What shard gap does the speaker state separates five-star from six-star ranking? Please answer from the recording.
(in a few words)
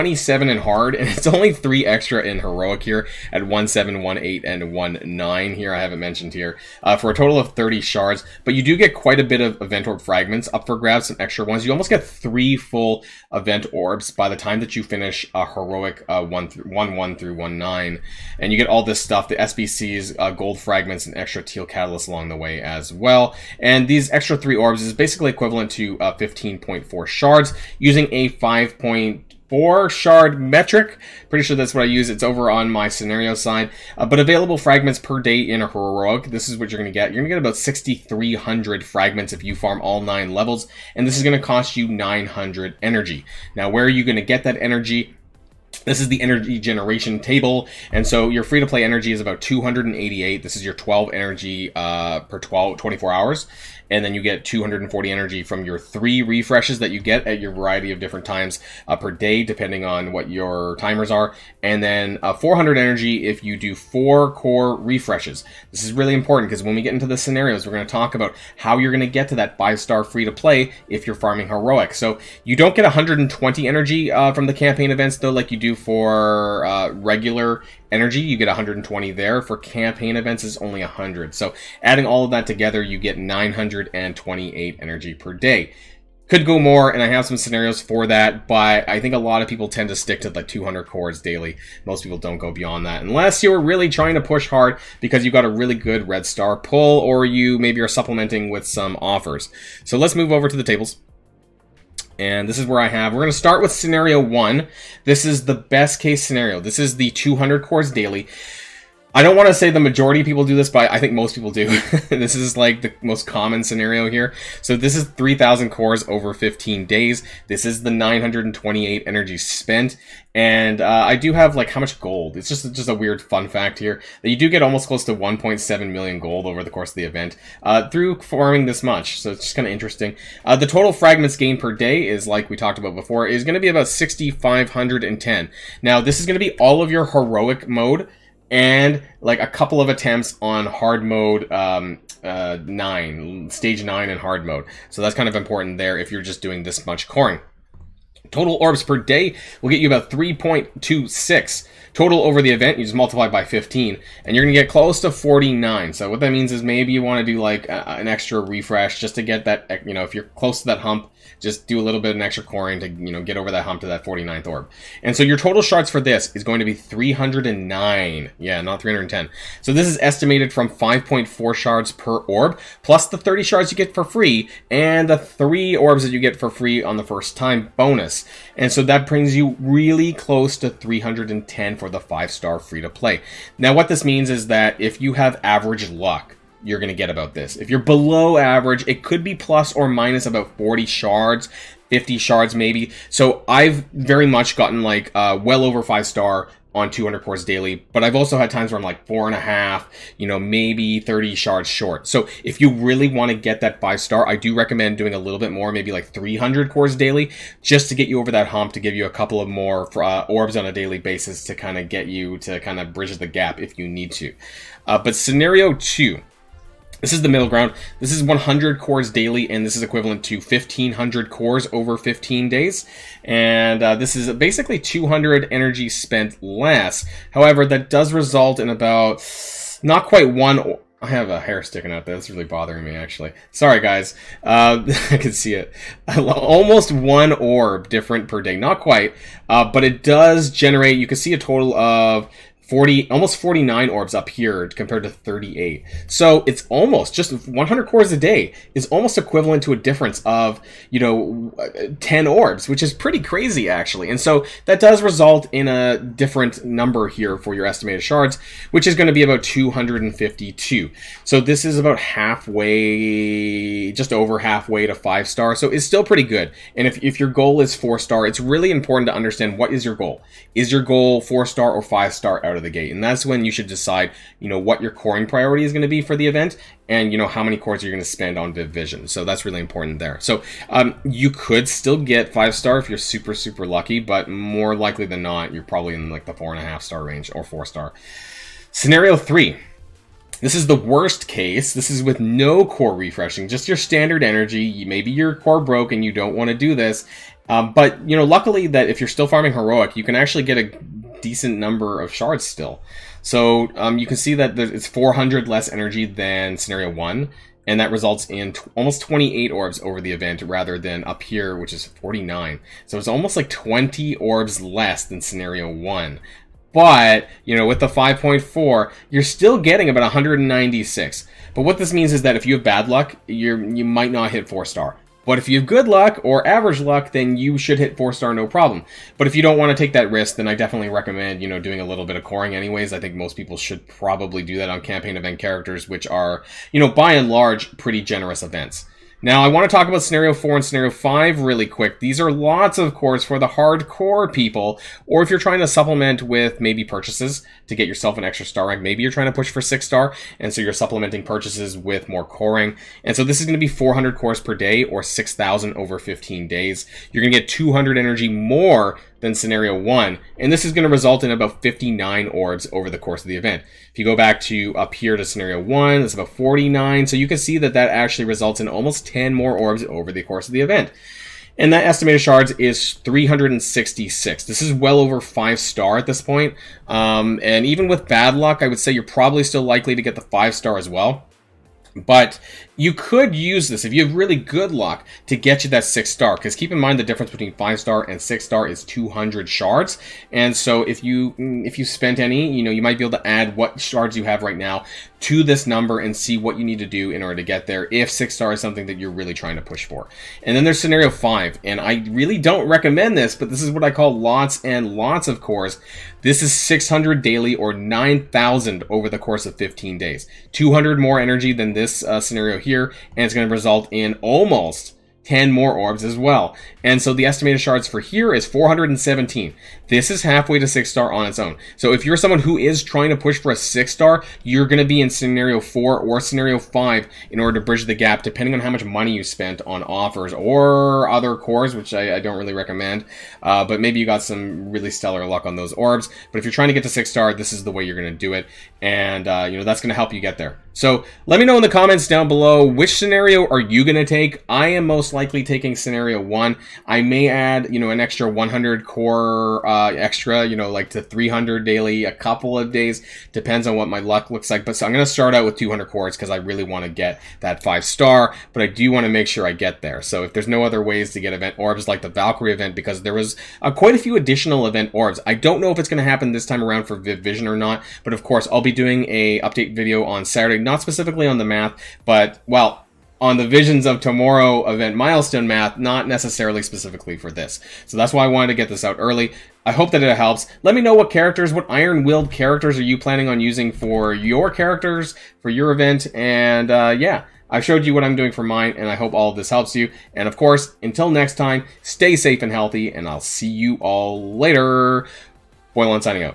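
200 shards.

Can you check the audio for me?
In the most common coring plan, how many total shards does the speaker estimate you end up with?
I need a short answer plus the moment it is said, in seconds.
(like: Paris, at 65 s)
309, at 166 s.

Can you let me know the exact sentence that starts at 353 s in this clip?
And so this is going to be 400 cores per day or 6,000 over 15 days.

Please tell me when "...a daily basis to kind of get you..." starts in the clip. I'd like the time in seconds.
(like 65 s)
210 s.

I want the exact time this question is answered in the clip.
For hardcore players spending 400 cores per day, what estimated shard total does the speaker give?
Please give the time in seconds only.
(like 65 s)
372 s.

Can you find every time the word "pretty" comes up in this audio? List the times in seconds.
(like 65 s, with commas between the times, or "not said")
31 s, 252 s, 266 s, 337 s.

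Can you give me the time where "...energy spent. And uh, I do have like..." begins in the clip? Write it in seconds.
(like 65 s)
119 s.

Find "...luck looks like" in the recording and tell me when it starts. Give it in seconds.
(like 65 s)
453 s.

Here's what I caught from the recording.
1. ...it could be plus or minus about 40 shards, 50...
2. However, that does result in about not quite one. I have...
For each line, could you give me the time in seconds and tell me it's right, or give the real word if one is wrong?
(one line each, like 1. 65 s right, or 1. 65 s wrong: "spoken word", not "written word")
1. 188 s right
2. 227 s right.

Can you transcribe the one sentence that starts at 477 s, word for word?
So that's why I wanted to get this out early.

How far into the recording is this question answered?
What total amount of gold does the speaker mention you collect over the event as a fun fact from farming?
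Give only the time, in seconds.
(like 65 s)
125 s.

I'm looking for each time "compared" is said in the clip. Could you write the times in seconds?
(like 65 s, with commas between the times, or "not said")
244 s.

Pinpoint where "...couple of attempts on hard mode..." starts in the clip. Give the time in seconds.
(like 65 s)
139 s.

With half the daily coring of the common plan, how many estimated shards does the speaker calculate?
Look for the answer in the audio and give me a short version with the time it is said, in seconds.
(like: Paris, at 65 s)
252, at 259 s.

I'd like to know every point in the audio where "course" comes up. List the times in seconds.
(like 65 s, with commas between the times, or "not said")
126 s, 342 s, 362 s, 370 s, 409 s, 468 s, 490 s.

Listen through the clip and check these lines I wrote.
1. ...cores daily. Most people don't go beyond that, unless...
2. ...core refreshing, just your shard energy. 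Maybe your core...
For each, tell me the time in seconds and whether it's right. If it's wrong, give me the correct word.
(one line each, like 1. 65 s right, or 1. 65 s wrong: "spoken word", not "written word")
1. 90 s right
2. 292 s wrong: "standard", not "shard".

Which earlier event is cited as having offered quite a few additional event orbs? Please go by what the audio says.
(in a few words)
Valkyrie event.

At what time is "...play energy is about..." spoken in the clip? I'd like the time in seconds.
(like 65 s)
48 s.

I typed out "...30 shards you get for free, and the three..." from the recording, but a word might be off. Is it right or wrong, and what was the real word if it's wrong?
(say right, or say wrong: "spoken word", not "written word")
right.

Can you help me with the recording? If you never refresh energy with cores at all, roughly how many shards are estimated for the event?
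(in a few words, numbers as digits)
196.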